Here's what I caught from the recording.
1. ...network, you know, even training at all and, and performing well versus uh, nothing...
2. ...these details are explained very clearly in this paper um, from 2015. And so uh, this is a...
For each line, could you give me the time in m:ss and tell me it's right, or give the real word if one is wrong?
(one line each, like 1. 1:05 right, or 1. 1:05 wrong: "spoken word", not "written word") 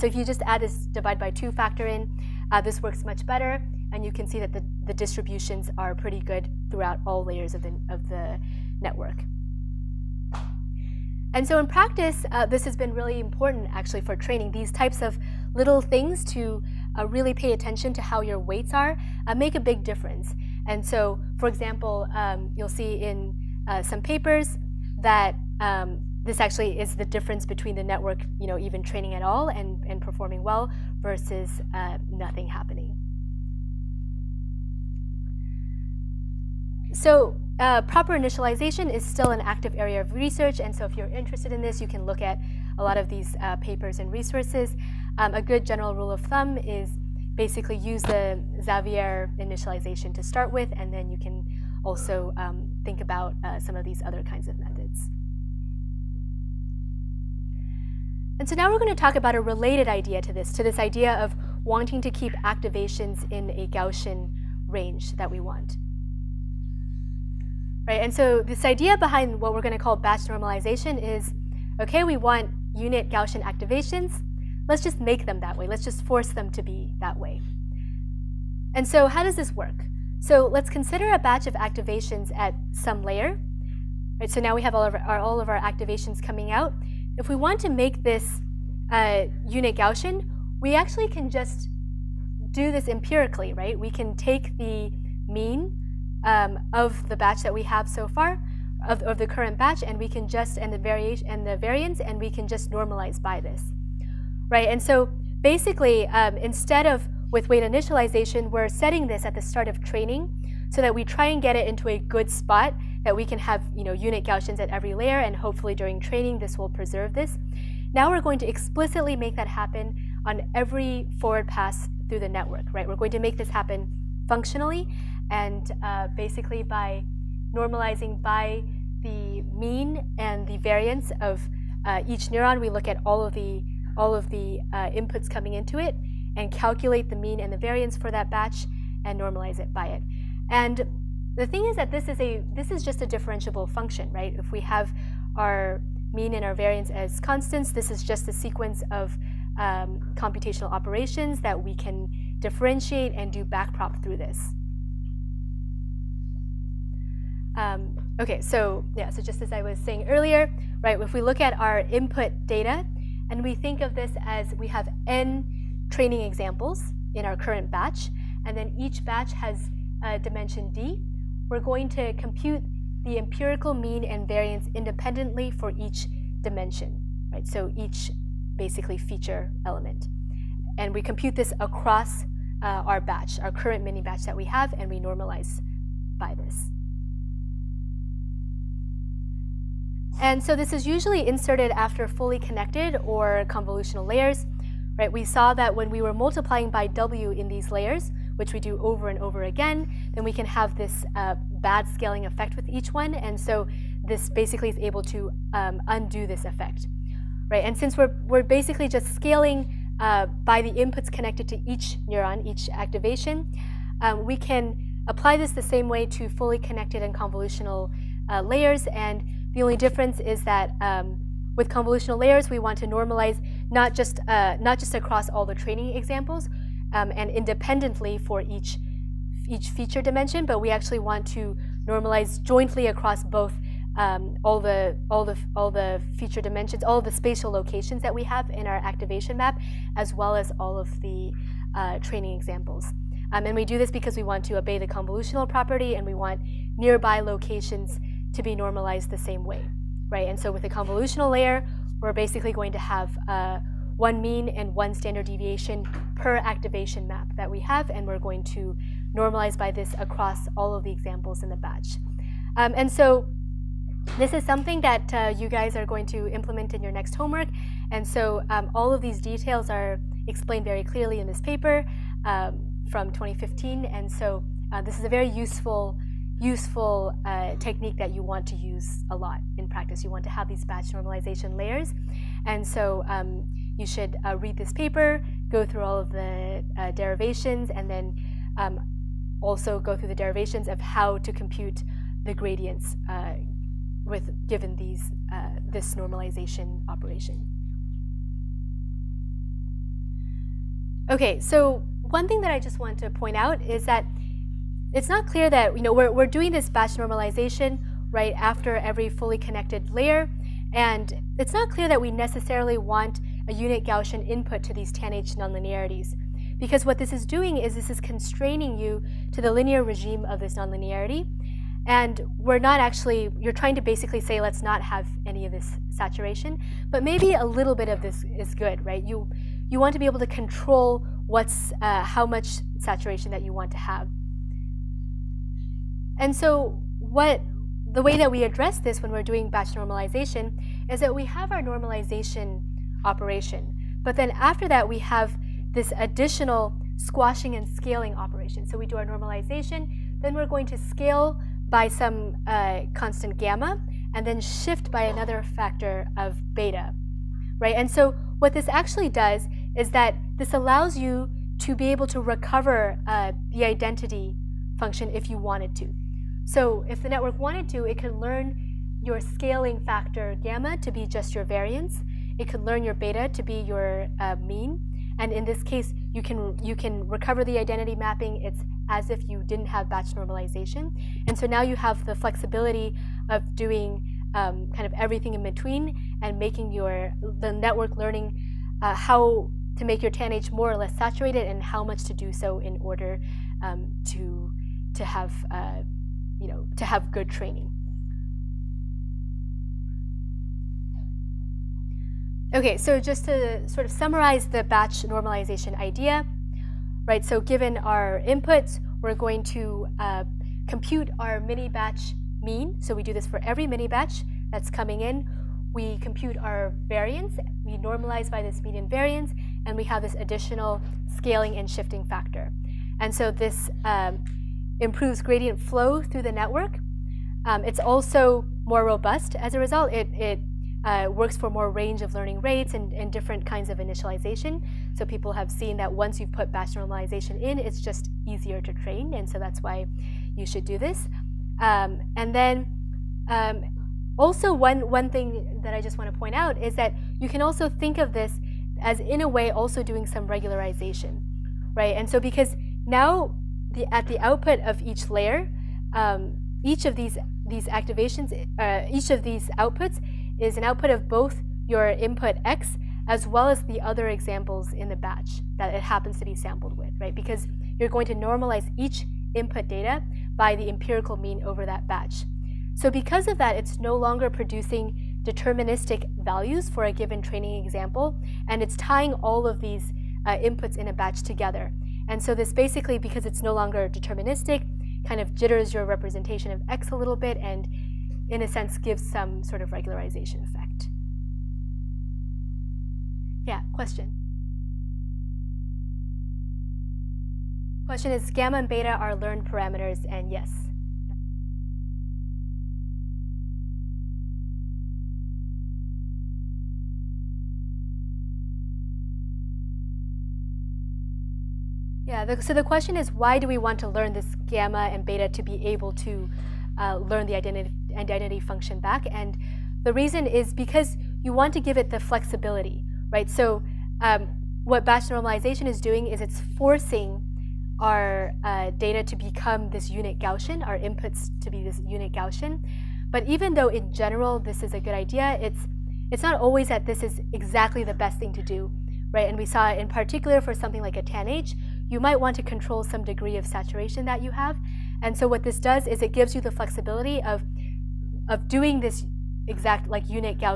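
1. 0:27 right
2. 4:29 right.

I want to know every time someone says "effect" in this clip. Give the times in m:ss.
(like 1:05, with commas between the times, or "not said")
3:22, 3:26, 8:10.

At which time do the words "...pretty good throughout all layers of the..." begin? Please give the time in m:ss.
0:05.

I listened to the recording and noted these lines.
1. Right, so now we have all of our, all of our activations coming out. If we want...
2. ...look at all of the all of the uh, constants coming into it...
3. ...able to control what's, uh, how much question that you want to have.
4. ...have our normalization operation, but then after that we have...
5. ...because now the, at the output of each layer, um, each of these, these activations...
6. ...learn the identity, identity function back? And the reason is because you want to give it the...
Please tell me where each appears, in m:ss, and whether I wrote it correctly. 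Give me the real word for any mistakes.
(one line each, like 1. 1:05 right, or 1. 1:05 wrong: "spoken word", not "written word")
1. 1:24 right
2. 2:12 wrong: "inputs", not "constants"
3. 5:30 wrong: "saturation", not "question"
4. 5:41 right
5. 7:32 right
6. 8:36 right.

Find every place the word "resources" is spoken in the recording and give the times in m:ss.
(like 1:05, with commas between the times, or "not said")
0:44.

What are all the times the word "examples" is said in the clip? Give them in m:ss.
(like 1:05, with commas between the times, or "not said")
0:21, 2:46, 3:45, 4:02, 4:20, 7:44, 7:57.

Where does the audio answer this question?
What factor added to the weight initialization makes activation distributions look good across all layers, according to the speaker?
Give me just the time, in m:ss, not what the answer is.
0:00.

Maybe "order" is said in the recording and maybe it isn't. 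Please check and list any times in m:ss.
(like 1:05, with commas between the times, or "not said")
6:32.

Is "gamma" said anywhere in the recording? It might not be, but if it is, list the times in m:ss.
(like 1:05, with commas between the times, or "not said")
5:53, 6:10, 8:18, 8:34.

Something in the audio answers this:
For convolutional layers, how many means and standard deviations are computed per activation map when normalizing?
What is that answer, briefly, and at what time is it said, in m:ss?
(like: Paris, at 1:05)
1, at 4:13.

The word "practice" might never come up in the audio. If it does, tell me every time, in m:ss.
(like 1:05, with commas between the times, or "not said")
0:11, 4:39.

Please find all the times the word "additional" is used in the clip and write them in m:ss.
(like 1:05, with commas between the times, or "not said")
5:45, 7:00.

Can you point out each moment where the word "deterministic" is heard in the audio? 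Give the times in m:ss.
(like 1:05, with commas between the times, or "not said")
7:55, 8:03.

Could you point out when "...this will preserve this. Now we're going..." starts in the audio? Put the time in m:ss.
1:56.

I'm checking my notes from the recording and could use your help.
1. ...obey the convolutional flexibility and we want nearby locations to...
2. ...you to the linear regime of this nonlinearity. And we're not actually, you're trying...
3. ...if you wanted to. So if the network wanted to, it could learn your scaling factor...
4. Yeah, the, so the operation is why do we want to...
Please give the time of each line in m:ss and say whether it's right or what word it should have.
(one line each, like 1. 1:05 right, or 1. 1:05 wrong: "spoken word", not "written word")
1. 4:04 wrong: "property", not "flexibility"
2. 5:18 right
3. 6:05 right
4. 8:32 wrong: "question", not "operation".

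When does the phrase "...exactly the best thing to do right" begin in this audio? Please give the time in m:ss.
8:57.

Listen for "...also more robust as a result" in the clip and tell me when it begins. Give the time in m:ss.
7:07.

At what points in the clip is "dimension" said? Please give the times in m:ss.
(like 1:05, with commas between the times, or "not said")
2:50, 2:56, 3:50, 3:56.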